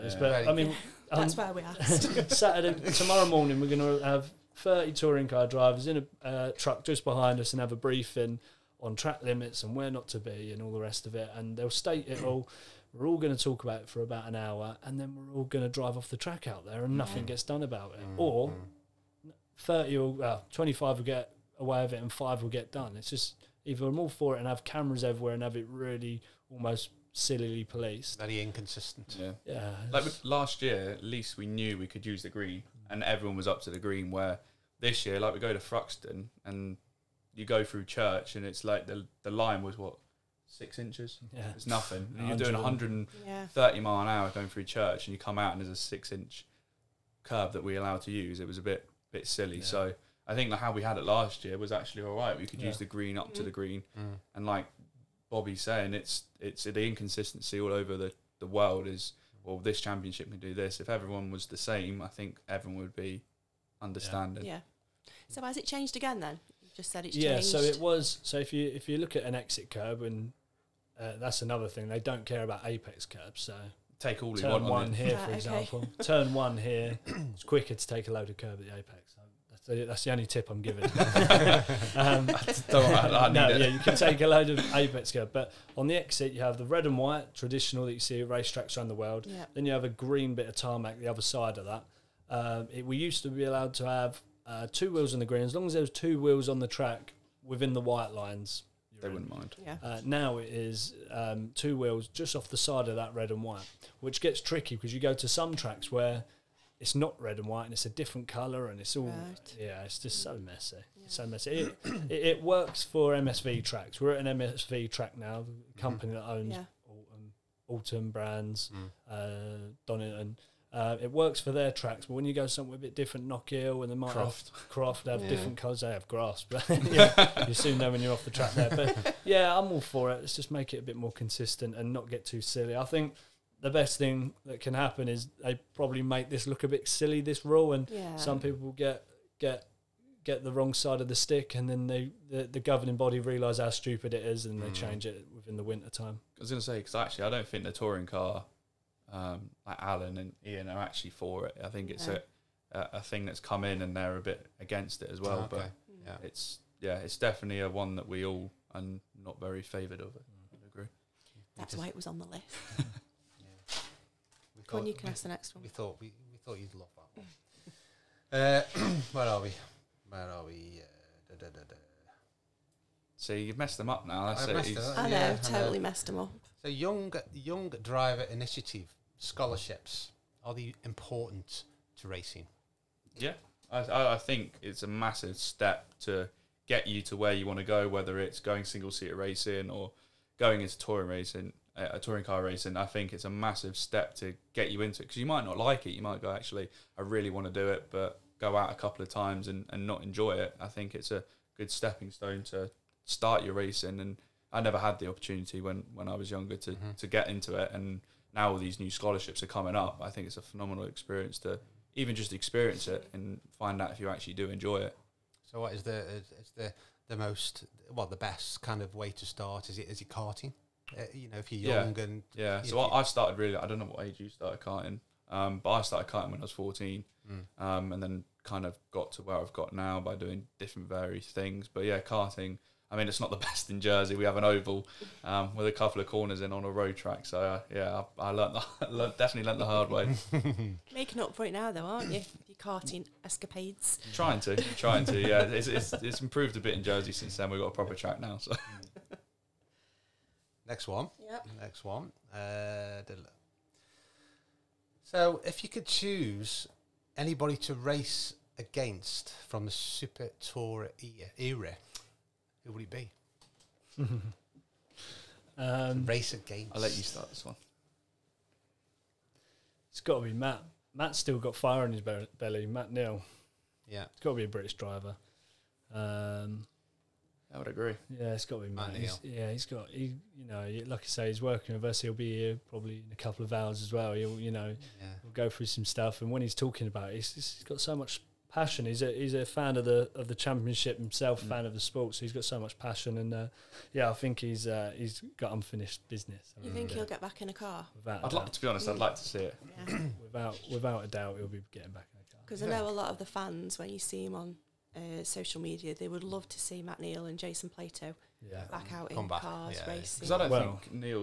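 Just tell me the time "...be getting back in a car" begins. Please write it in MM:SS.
05:01.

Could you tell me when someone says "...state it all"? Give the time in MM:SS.
00:11.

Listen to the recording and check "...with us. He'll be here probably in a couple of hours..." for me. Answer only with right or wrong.
right.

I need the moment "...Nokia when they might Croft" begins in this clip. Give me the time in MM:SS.
02:03.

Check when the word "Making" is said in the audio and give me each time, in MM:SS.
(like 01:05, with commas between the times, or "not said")
04:00.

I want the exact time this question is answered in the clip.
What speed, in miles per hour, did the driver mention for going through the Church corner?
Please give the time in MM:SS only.
00:42.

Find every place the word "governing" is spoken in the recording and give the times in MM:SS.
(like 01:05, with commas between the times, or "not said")
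02:22.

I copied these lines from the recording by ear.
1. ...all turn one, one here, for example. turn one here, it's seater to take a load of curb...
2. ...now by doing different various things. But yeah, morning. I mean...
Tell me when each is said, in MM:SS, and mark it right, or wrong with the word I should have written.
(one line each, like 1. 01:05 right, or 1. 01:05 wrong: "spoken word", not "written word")
1. 01:14 wrong: "quicker", not "seater"
2. 03:49 wrong: "karting", not "morning".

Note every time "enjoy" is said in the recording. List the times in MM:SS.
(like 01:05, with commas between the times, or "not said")
03:20, 03:34.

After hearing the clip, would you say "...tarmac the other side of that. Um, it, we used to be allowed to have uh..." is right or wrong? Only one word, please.
right.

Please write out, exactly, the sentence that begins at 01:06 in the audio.
You just said it's yeah, changed.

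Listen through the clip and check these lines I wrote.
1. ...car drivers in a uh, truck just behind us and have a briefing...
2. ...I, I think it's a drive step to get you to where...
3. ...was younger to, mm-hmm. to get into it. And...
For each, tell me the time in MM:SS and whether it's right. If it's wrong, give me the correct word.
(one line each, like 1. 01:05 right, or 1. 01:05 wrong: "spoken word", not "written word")
1. 00:05 right
2. 03:03 wrong: "massive", not "drive"
3. 03:26 right.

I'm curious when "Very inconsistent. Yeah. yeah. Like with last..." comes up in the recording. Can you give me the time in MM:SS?
00:28.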